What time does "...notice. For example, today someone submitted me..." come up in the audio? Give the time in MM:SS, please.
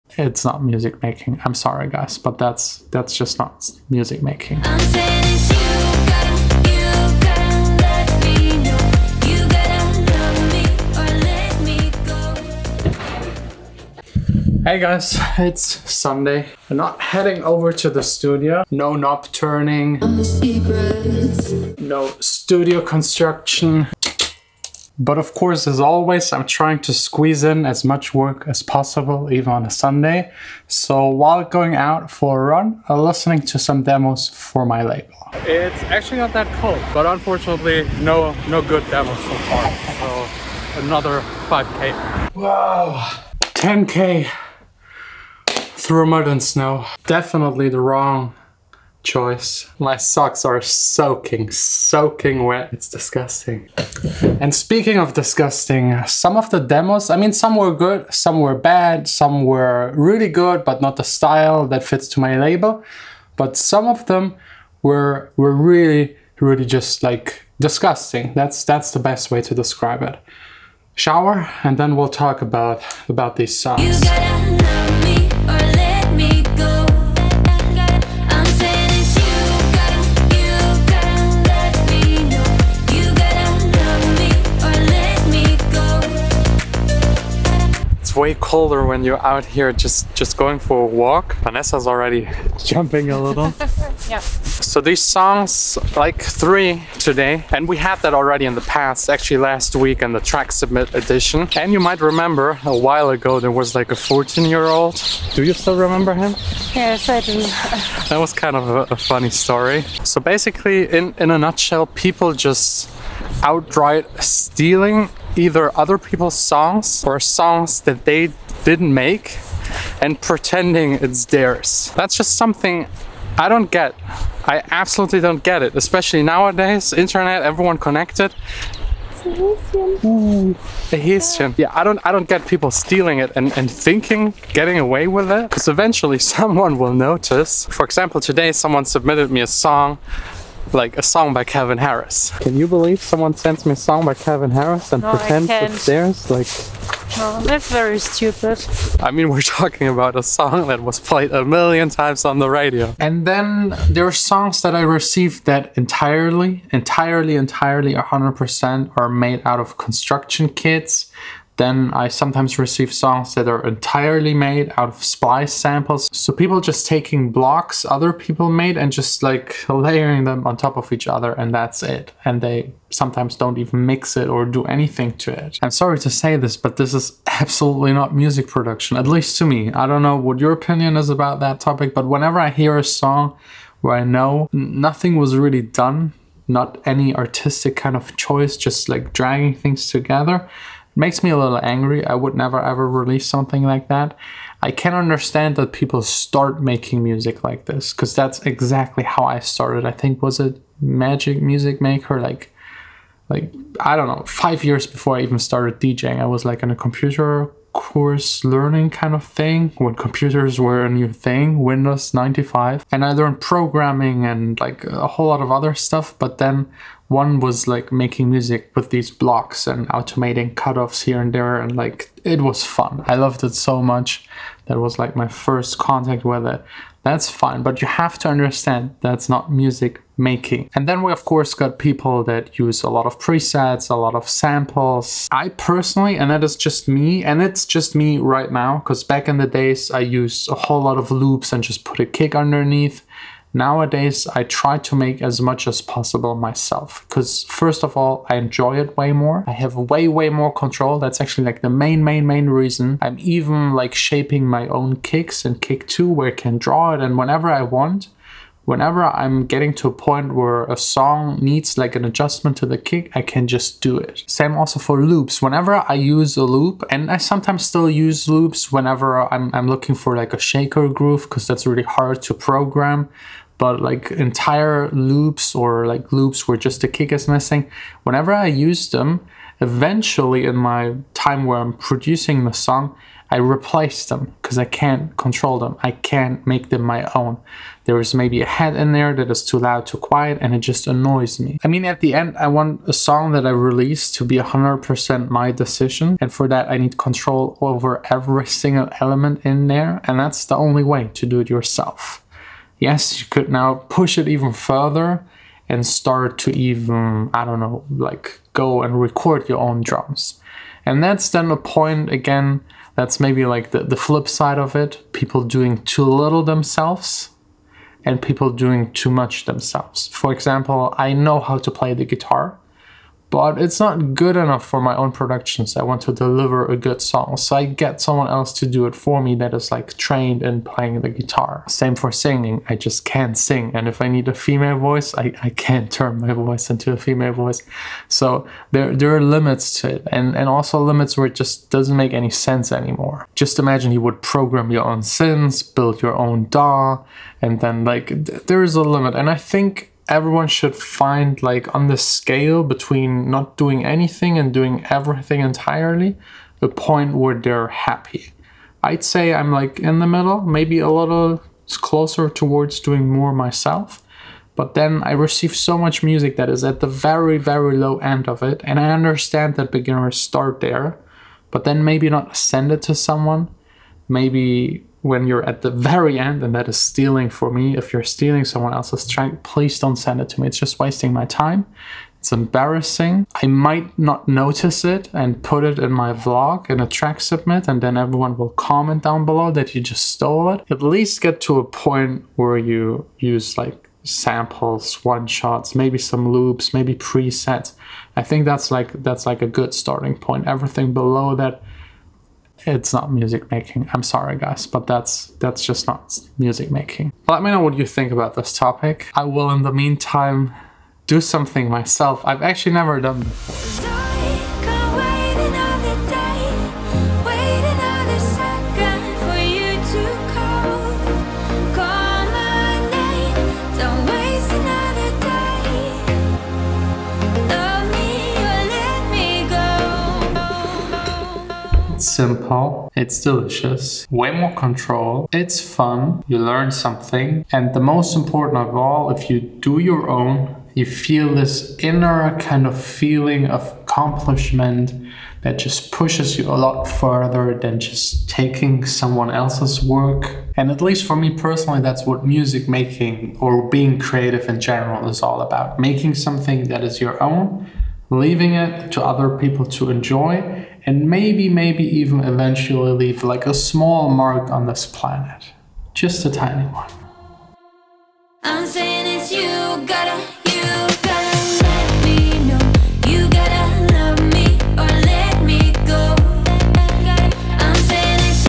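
02:16.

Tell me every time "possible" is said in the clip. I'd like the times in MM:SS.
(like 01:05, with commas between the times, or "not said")
00:28, 04:05.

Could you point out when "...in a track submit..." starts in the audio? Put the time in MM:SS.
06:26.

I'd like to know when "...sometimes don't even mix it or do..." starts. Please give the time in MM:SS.
02:52.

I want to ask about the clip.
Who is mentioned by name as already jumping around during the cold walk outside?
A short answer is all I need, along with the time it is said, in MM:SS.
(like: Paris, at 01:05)
Vanessa, at 01:31.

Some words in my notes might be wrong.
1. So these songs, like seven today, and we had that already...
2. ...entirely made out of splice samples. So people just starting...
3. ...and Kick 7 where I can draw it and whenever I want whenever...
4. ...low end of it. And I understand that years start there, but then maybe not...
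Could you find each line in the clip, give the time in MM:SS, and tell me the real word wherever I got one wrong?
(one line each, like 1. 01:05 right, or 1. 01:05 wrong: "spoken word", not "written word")
1. 01:34 wrong: "three", not "seven"
2. 02:43 wrong: "taking", not "starting"
3. 04:15 wrong: "2", not "7"
4. 06:07 wrong: "beginners", not "years".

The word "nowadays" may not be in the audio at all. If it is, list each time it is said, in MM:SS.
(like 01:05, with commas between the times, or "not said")
02:06, 04:03.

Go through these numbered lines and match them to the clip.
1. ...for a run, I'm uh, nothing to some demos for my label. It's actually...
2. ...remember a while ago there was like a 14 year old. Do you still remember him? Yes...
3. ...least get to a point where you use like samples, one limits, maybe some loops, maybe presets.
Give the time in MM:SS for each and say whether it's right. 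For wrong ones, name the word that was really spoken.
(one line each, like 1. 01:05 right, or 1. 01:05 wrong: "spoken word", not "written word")
1. 00:32 wrong: "listening", not "nothing"
2. 01:42 right
3. 06:30 wrong: "shots", not "limits".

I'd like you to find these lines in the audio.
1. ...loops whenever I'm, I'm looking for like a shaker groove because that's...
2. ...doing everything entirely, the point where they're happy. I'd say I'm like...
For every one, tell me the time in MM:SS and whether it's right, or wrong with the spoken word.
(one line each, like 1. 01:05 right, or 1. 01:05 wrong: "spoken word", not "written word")
1. 04:28 right
2. 05:54 right.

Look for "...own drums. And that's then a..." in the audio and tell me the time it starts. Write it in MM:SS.
05:09.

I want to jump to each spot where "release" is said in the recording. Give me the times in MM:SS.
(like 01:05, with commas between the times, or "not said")
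03:12, 04:53.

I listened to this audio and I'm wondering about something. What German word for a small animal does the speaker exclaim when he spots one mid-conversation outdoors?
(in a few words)
Häschen.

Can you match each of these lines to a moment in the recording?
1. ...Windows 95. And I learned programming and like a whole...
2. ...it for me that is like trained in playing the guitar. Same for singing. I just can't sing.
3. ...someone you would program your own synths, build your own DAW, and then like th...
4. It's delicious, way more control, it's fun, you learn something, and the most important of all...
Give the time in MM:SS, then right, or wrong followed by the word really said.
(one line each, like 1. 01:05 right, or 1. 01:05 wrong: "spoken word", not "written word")
1. 03:31 right
2. 05:28 right
3. 05:43 wrong: "imagine", not "someone"
4. 07:12 right.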